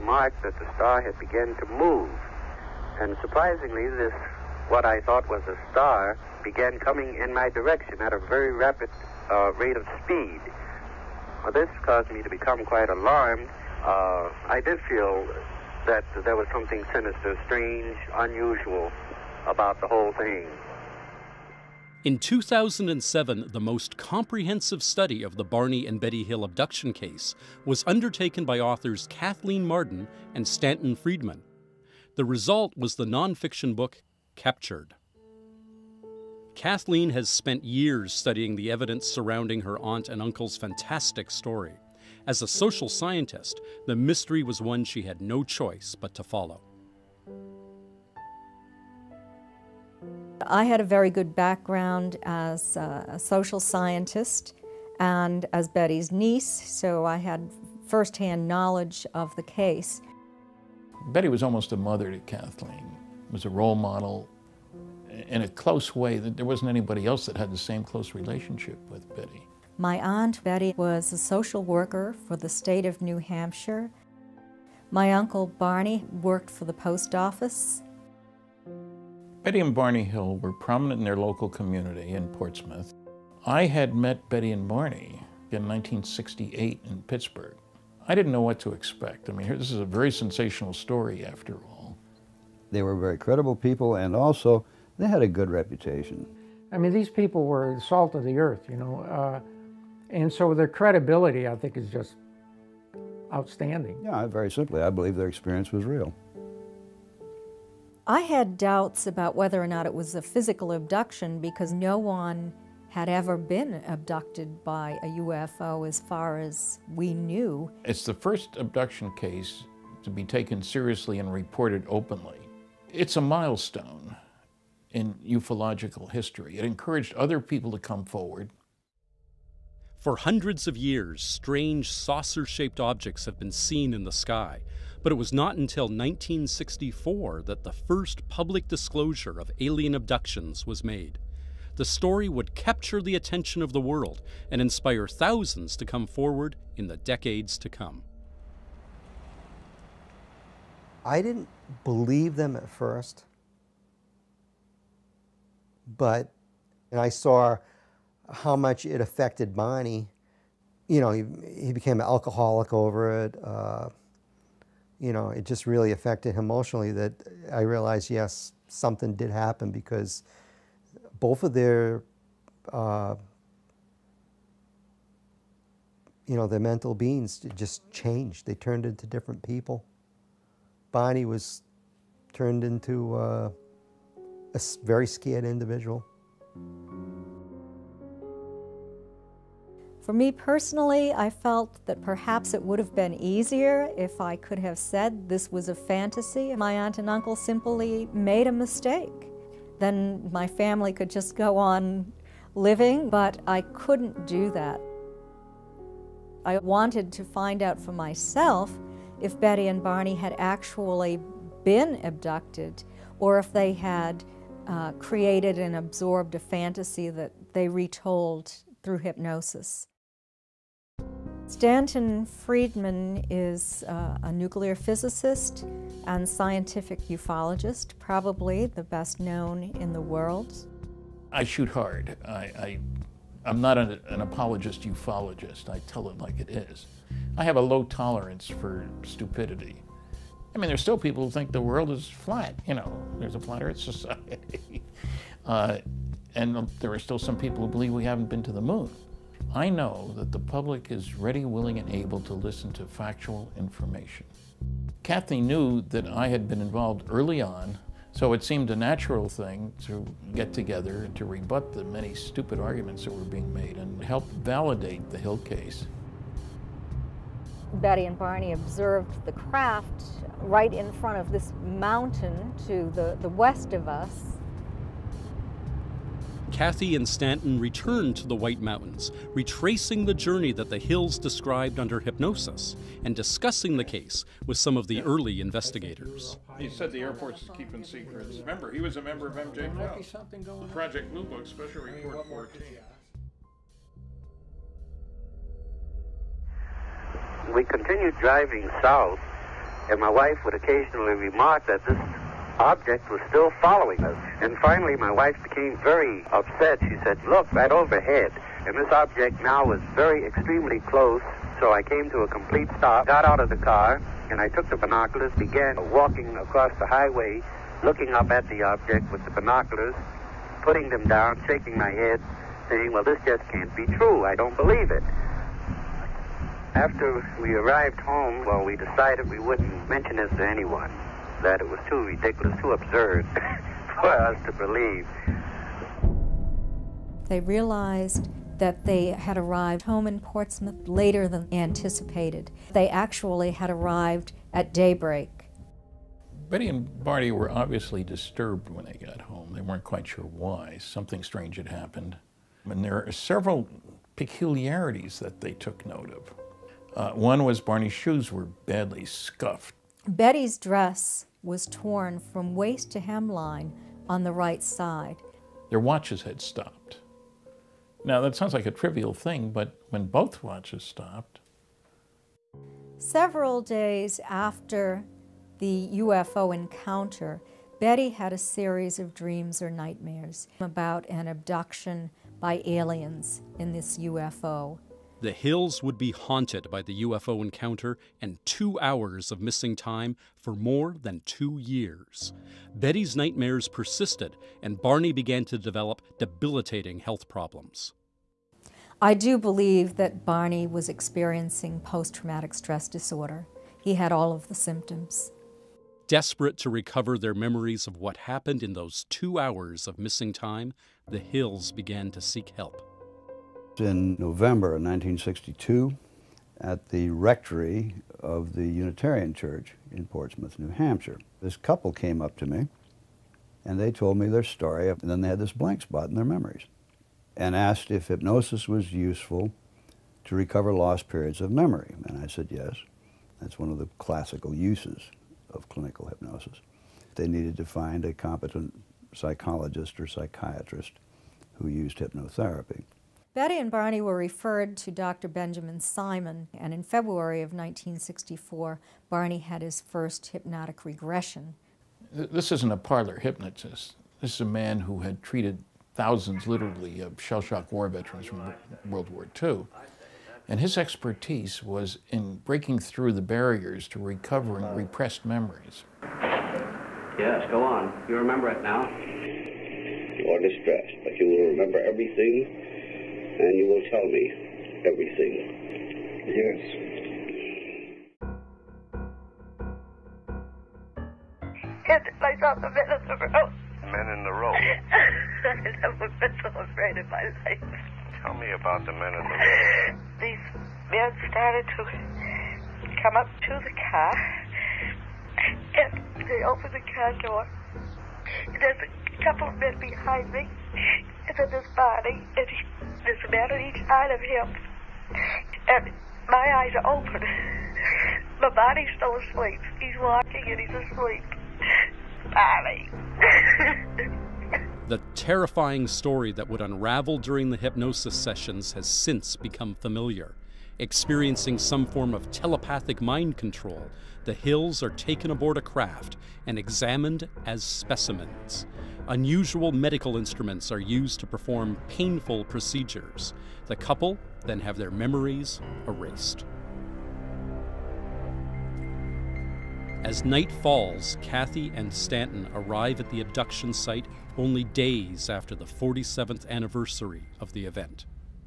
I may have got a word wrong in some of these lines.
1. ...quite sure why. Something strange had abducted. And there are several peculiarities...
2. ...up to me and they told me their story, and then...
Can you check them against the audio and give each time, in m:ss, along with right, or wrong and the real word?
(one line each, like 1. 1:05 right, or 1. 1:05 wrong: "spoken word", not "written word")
1. 5:49 wrong: "happened", not "abducted"
2. 7:02 right.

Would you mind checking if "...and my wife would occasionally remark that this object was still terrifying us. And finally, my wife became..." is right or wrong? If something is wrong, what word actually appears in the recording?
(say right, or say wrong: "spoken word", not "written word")
wrong: "following", not "terrifying".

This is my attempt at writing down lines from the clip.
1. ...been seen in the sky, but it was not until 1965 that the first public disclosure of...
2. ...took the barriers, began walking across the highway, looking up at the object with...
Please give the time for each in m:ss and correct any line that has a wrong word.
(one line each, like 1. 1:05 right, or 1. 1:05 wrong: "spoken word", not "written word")
1. 2:13 wrong: "1964", not "1965"
2. 5:14 wrong: "binoculars", not "barriers".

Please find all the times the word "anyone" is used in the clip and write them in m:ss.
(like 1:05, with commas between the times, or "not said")
5:30.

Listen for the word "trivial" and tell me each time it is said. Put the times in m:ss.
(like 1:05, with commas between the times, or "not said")
6:08.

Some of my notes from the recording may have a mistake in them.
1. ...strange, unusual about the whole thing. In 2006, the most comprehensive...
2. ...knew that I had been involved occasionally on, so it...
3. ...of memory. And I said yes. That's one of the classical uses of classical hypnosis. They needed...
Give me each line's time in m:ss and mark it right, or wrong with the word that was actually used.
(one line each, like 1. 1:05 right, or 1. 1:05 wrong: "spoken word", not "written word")
1. 0:17 wrong: "2007", not "2006"
2. 4:15 wrong: "early", not "occasionally"
3. 7:11 wrong: "clinical", not "classical".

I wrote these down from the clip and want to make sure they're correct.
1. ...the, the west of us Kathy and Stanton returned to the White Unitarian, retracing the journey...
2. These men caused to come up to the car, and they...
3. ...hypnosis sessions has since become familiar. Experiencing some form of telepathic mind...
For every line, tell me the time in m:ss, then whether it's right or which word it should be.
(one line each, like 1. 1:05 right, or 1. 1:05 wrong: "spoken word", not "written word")
1. 4:32 wrong: "Mountains", not "Unitarian"
2. 8:10 wrong: "started", not "caused"
3. 8:37 right.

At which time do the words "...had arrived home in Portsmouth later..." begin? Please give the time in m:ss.
5:39.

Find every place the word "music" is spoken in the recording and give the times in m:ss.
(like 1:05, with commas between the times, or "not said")
not said.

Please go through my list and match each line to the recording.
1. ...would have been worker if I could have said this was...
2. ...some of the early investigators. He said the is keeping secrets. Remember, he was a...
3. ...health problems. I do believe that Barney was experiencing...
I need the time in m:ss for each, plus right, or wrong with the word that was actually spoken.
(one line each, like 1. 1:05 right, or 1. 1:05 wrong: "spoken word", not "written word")
1. 3:12 wrong: "easier", not "worker"
2. 4:44 right
3. 6:36 right.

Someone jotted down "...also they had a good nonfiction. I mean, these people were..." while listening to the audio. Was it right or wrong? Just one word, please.
wrong.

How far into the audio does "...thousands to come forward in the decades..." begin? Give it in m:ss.
2:25.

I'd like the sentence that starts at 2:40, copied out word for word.
You know, he, he became an alcoholic over it.